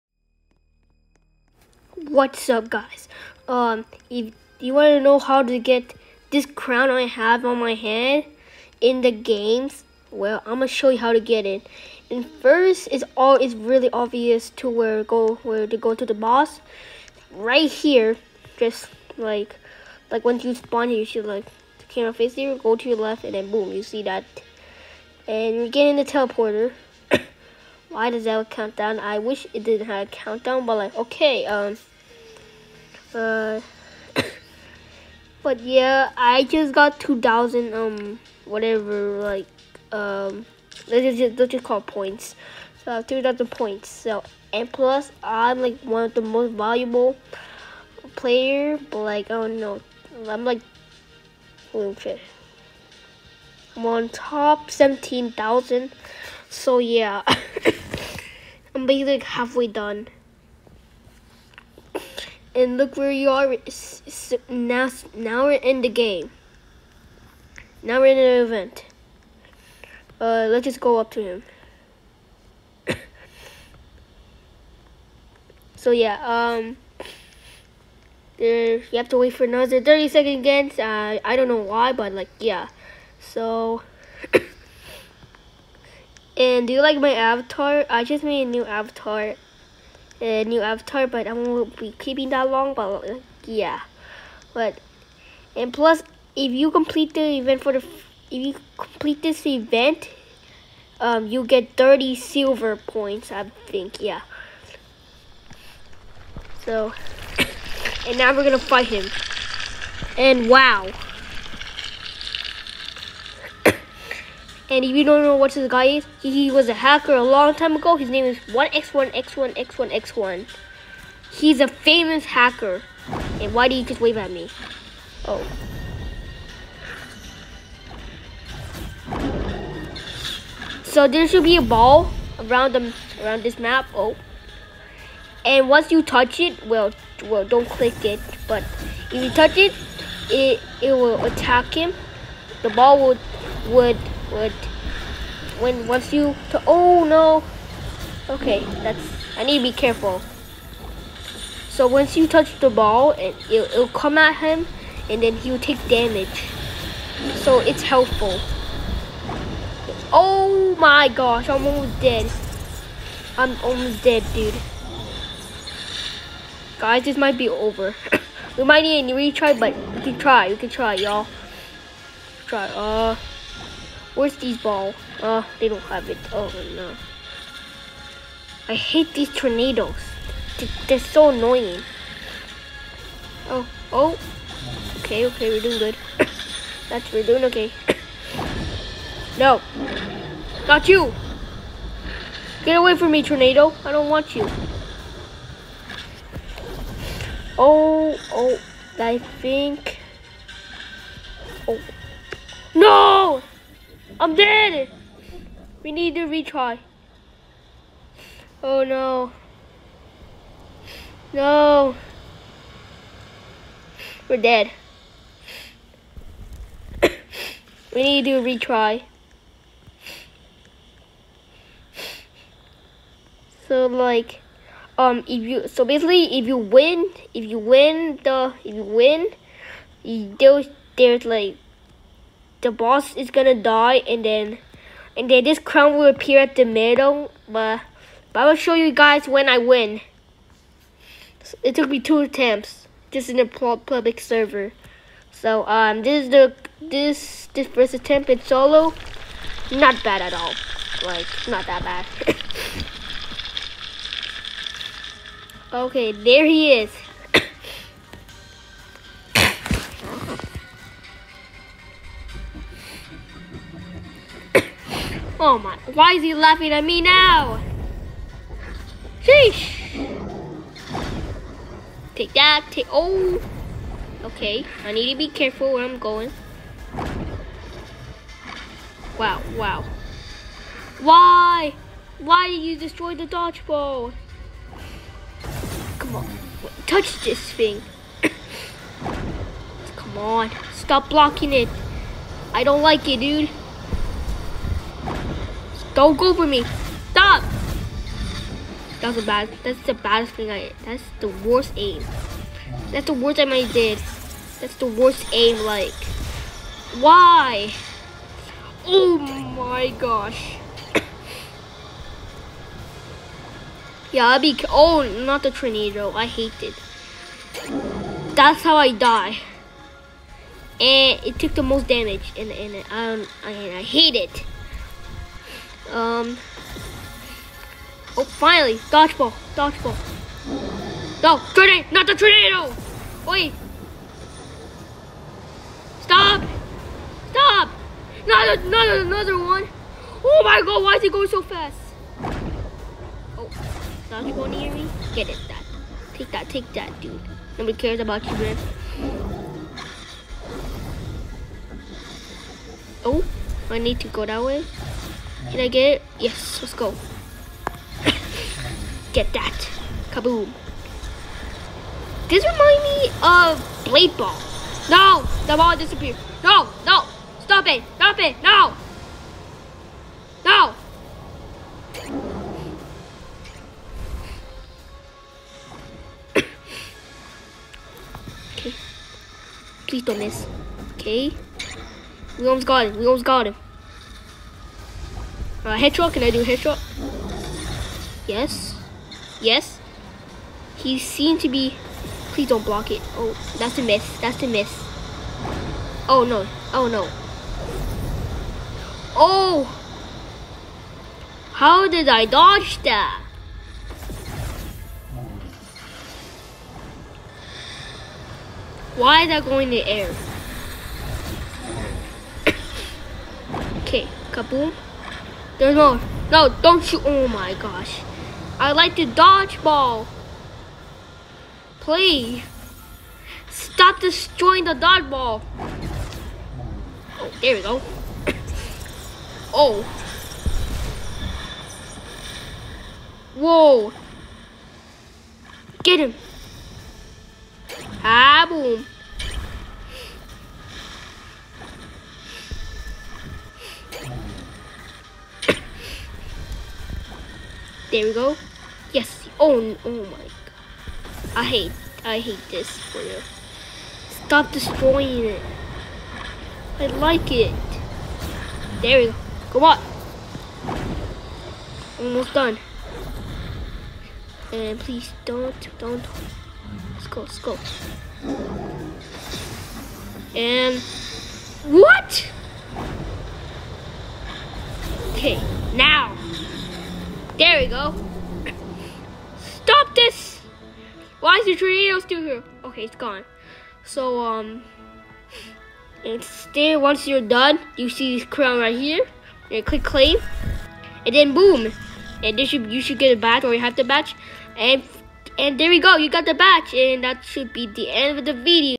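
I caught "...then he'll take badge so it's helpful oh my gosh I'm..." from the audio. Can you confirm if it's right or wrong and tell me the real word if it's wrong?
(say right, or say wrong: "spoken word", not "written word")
wrong: "damage", not "badge".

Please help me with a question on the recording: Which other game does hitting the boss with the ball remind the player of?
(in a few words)
Blade Ball.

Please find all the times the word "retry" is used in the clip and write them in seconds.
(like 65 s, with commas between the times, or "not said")
169 s, 206 s, 218 s.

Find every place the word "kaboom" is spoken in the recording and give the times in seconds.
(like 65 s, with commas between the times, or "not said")
360 s, 414 s.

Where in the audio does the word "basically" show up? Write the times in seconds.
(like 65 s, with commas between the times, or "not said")
58 s, 225 s.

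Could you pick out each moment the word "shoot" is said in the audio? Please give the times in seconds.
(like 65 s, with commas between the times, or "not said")
416 s.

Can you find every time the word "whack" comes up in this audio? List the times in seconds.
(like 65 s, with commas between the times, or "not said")
not said.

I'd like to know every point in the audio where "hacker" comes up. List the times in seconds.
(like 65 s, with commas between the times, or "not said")
116 s, 122 s.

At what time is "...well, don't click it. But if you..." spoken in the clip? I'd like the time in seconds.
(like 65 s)
137 s.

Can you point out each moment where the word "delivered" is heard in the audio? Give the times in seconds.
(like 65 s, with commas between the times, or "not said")
not said.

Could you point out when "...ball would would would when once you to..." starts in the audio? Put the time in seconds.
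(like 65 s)
142 s.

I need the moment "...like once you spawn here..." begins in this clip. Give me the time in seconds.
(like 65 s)
20 s.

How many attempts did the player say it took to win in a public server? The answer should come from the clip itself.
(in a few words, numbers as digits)
2.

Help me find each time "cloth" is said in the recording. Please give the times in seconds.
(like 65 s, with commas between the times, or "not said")
not said.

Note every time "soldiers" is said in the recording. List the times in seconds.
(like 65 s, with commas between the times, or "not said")
not said.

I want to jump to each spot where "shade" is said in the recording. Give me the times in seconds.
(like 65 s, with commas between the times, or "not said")
not said.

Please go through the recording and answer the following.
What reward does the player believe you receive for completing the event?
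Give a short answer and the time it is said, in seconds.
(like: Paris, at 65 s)
30 silver points, at 101 s.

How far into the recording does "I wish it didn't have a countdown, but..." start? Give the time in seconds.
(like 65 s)
28 s.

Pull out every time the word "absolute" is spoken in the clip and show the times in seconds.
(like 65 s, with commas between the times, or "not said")
not said.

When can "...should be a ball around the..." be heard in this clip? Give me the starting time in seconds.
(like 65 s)
131 s.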